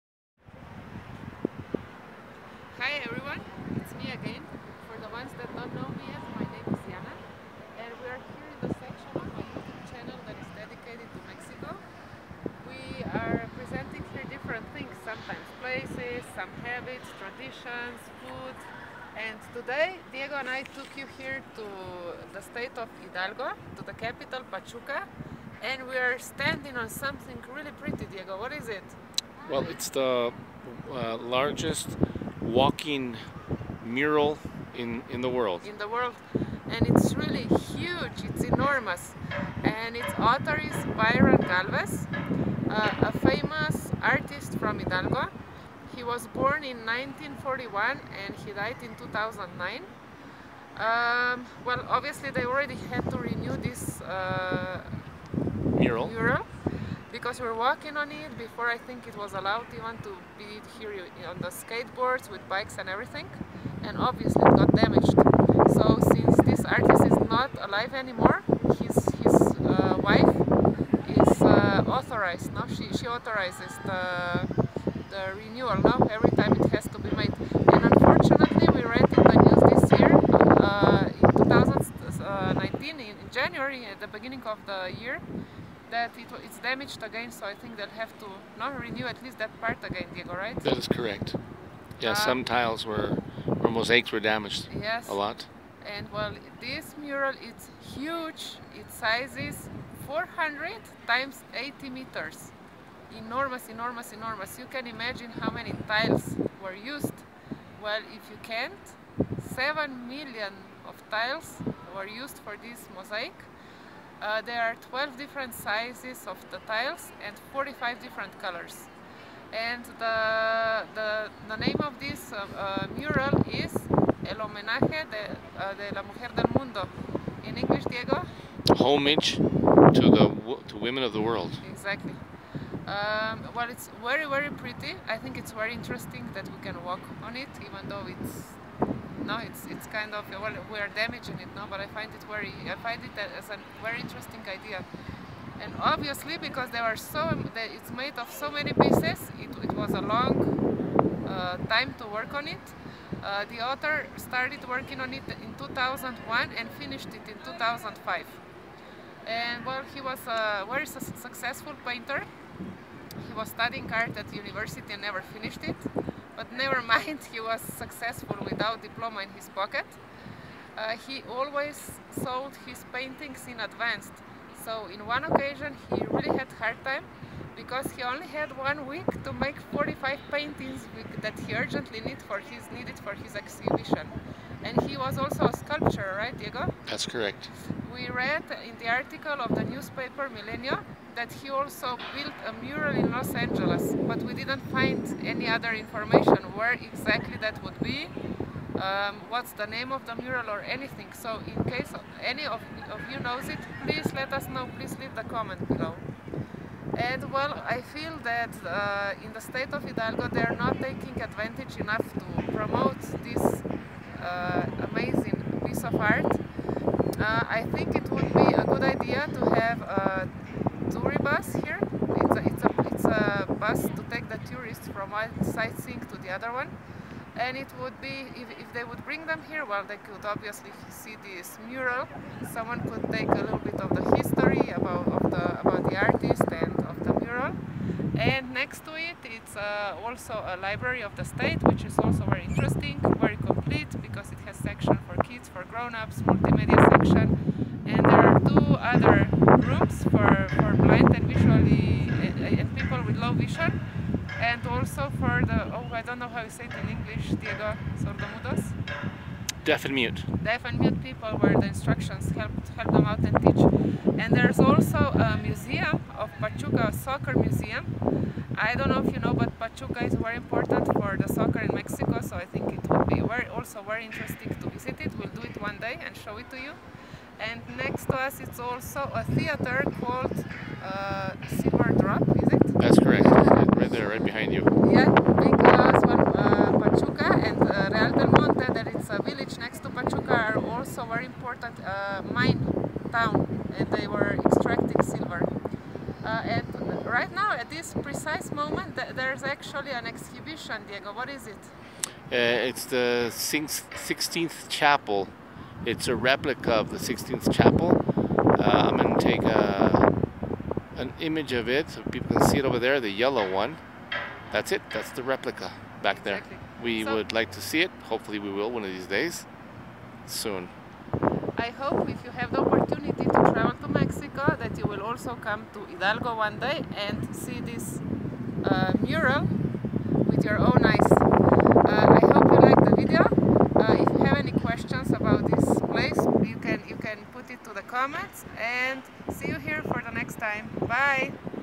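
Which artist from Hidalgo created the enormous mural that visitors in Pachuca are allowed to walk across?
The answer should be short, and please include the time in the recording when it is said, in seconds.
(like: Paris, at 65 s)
Byron Galvez, at 40 s.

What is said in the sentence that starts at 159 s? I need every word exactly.
And well, he was a very su successful painter.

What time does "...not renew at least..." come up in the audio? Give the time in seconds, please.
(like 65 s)
88 s.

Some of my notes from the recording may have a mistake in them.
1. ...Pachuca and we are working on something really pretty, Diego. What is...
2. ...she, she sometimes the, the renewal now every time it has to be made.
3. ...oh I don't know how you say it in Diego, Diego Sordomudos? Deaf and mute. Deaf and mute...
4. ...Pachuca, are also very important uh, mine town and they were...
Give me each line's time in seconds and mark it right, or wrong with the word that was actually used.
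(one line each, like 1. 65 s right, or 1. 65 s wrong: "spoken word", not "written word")
1. 24 s wrong: "standing", not "working"
2. 72 s wrong: "authorizes", not "sometimes"
3. 255 s wrong: "English", not "Diego"
4. 289 s right.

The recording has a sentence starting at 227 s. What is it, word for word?
And it would be, if, if they would bring them here, well, they could obviously see this mural.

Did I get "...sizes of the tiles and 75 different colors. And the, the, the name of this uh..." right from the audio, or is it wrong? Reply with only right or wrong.
wrong.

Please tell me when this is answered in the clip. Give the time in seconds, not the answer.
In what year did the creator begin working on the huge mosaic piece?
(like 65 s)
155 s.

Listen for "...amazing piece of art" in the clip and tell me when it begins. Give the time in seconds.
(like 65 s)
214 s.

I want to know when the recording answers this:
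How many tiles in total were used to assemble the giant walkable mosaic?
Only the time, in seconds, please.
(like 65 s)
109 s.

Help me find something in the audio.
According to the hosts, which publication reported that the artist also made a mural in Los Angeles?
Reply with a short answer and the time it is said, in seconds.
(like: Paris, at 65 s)
Millennium, at 190 s.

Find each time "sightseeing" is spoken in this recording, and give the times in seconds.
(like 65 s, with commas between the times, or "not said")
225 s.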